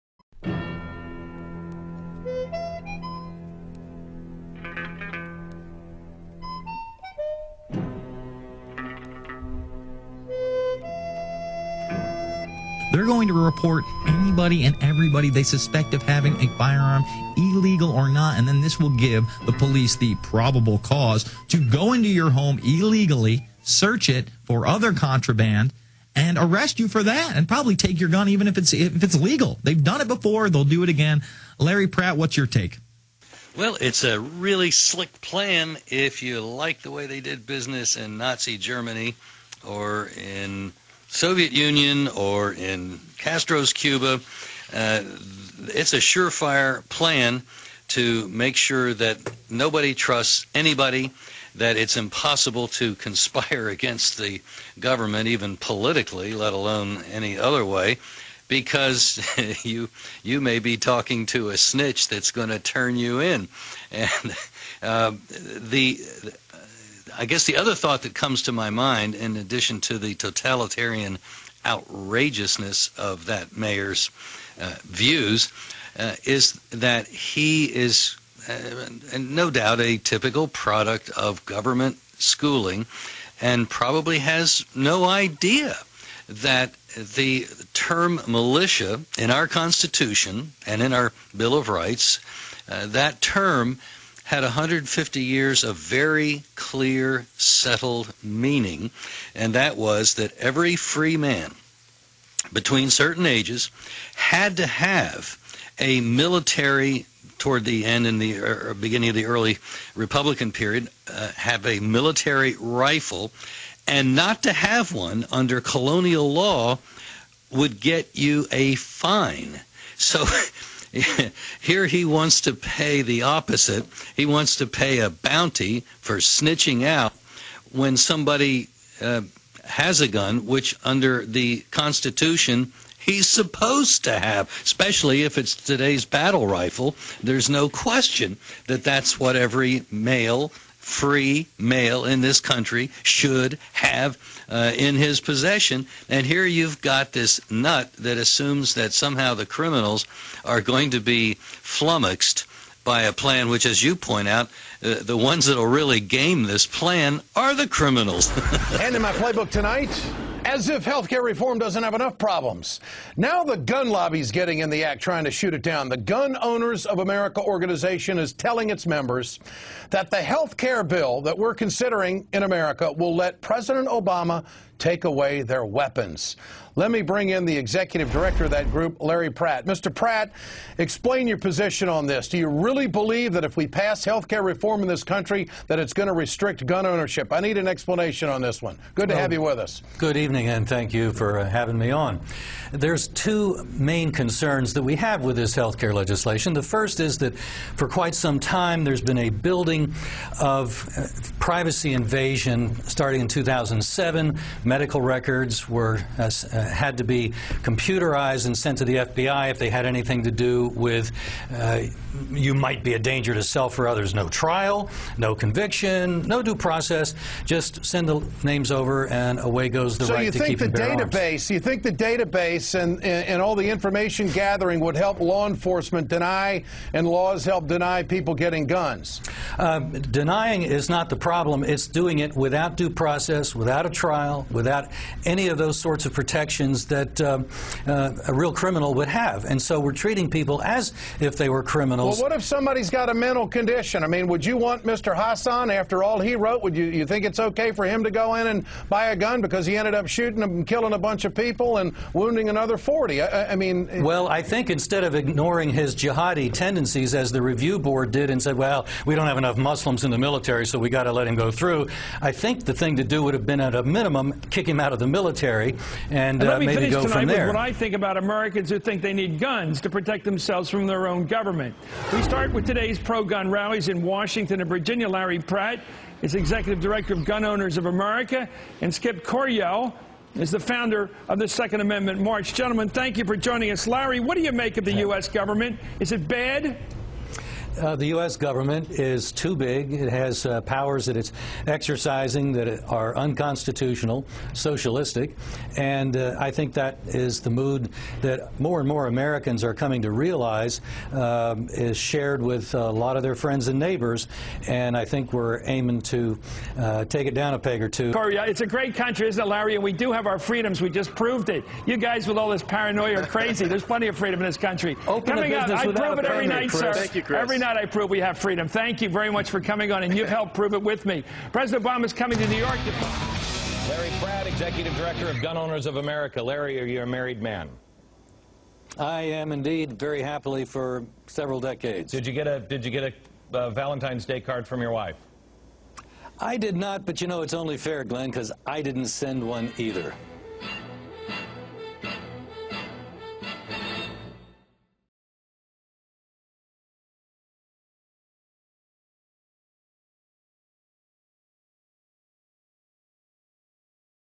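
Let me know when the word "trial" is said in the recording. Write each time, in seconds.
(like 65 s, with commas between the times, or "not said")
214 s, 233 s.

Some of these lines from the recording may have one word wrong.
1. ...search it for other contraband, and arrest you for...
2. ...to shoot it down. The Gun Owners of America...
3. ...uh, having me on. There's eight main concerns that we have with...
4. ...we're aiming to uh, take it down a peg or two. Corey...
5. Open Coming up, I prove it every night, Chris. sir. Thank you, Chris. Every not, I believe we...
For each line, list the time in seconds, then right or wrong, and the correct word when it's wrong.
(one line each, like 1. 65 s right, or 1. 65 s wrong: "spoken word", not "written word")
1. 23 s right
2. 165 s right
3. 191 s wrong: "two", not "eight"
4. 305 s right
5. 315 s wrong: "prove", not "believe".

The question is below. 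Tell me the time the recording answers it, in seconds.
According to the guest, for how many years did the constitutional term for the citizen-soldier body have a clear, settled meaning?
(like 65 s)
94 s.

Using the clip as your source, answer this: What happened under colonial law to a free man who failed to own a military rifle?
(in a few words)
a fine.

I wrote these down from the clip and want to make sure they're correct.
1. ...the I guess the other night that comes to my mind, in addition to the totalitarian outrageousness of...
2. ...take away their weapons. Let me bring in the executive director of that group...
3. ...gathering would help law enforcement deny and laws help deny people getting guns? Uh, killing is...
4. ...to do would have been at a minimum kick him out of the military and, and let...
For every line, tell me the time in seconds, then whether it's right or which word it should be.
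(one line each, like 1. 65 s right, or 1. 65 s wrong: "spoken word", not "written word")
1. 65 s wrong: "thought", not "night"
2. 174 s right
3. 224 s wrong: "denying", not "killing"
4. 262 s right.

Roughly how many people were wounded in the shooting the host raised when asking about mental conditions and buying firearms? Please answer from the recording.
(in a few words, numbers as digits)
40.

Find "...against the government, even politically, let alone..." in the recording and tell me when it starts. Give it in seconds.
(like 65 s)
53 s.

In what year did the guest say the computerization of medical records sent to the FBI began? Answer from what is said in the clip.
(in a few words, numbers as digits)
2007.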